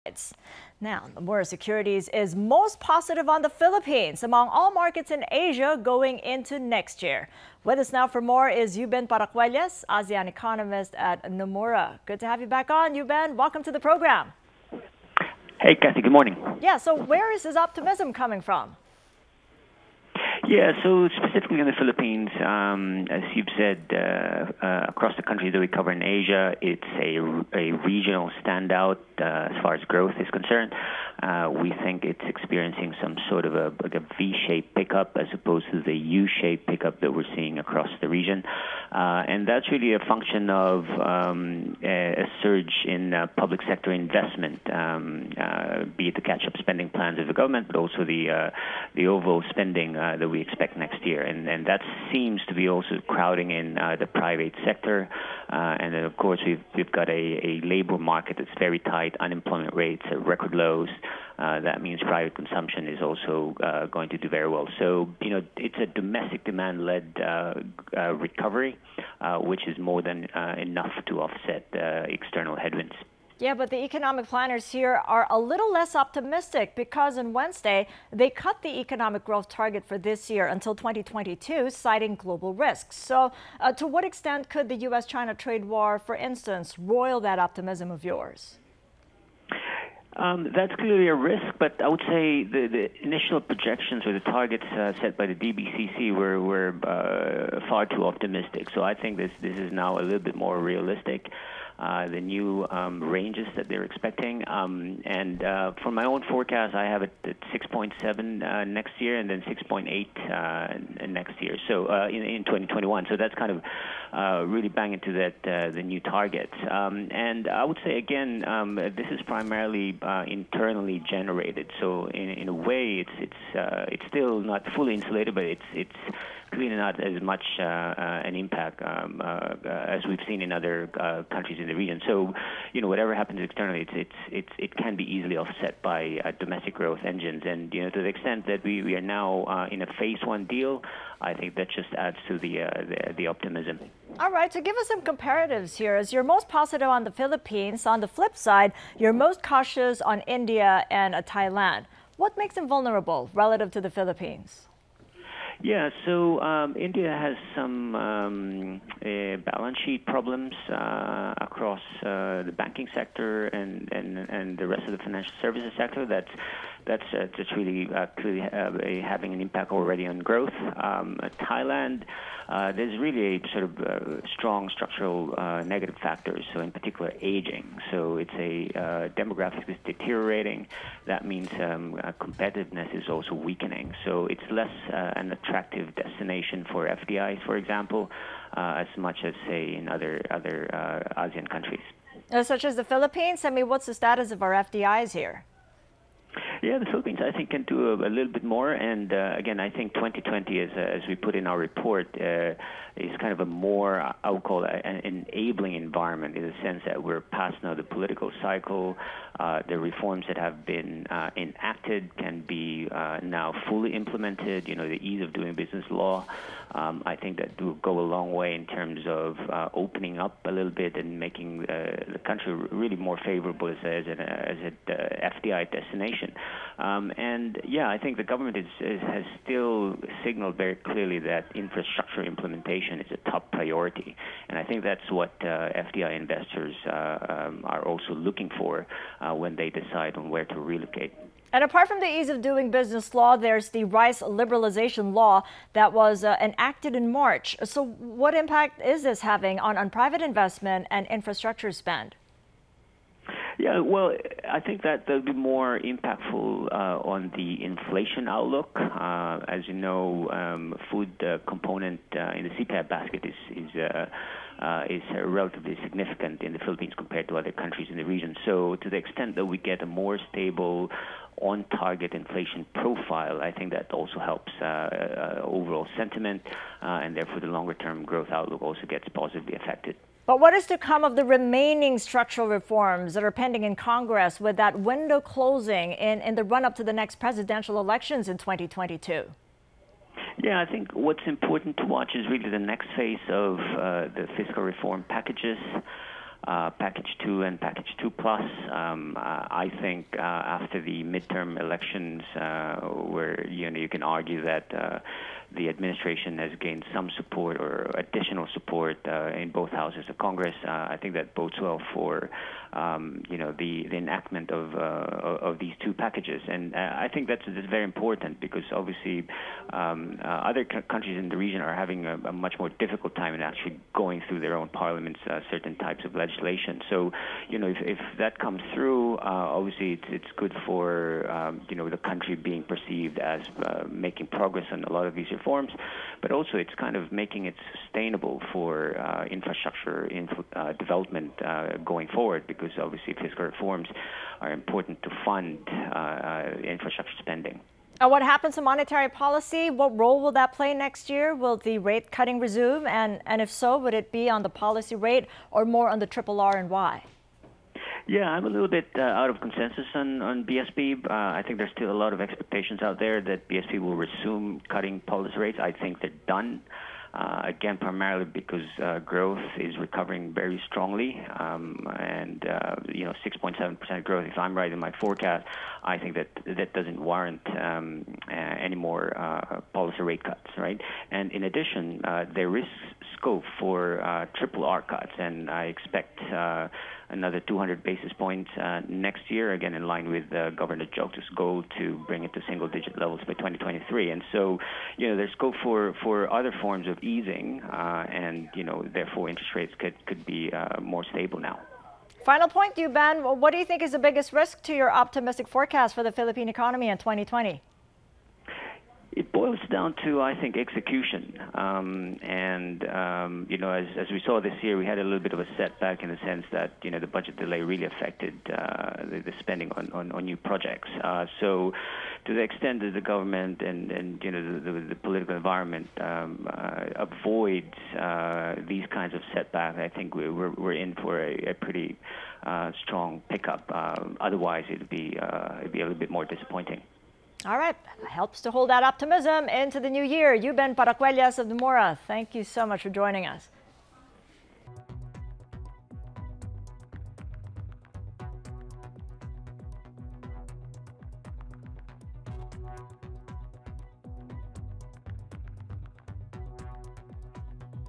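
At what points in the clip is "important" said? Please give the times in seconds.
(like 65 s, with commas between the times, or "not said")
291 s, 317 s, 344 s.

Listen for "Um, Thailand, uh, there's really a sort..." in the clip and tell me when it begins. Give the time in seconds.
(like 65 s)
170 s.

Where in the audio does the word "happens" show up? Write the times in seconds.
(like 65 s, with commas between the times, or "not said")
133 s, 348 s.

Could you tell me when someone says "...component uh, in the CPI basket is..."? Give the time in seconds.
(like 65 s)
261 s.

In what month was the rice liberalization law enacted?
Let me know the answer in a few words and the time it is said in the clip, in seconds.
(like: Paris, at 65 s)
March, at 247 s.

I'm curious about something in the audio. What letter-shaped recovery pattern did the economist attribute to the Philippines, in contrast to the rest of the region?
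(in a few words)
V-shaped.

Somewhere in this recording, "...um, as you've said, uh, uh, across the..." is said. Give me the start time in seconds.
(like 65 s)
22 s.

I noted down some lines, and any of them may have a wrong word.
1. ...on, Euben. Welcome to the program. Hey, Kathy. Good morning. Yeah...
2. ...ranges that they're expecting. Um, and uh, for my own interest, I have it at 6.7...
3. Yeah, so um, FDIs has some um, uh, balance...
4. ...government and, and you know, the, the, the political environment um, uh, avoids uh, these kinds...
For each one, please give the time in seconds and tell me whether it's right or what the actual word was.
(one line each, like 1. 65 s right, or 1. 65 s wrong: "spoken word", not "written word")
1. 12 s right
2. 103 s wrong: "forecast", not "interest"
3. 155 s wrong: "India", not "FDIs"
4. 423 s right.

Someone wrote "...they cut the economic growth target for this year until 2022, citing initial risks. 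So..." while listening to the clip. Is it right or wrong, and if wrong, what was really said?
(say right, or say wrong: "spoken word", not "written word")
wrong: "global", not "initial".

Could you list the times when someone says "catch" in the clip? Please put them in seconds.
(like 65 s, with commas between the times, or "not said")
46 s.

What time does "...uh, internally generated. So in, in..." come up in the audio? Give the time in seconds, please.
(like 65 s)
120 s.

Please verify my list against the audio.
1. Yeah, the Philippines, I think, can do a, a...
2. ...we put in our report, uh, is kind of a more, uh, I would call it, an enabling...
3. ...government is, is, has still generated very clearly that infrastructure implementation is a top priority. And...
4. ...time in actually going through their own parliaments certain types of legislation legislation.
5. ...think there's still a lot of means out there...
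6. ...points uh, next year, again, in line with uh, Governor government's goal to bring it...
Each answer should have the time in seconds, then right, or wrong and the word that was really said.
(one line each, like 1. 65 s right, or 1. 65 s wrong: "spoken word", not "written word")
1. 196 s right
2. 201 s right
3. 228 s wrong: "signaled", not "generated"
4. 323 s right
5. 361 s wrong: "expectations", not "means"
6. 388 s right.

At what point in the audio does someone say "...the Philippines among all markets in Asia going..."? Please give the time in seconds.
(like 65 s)
3 s.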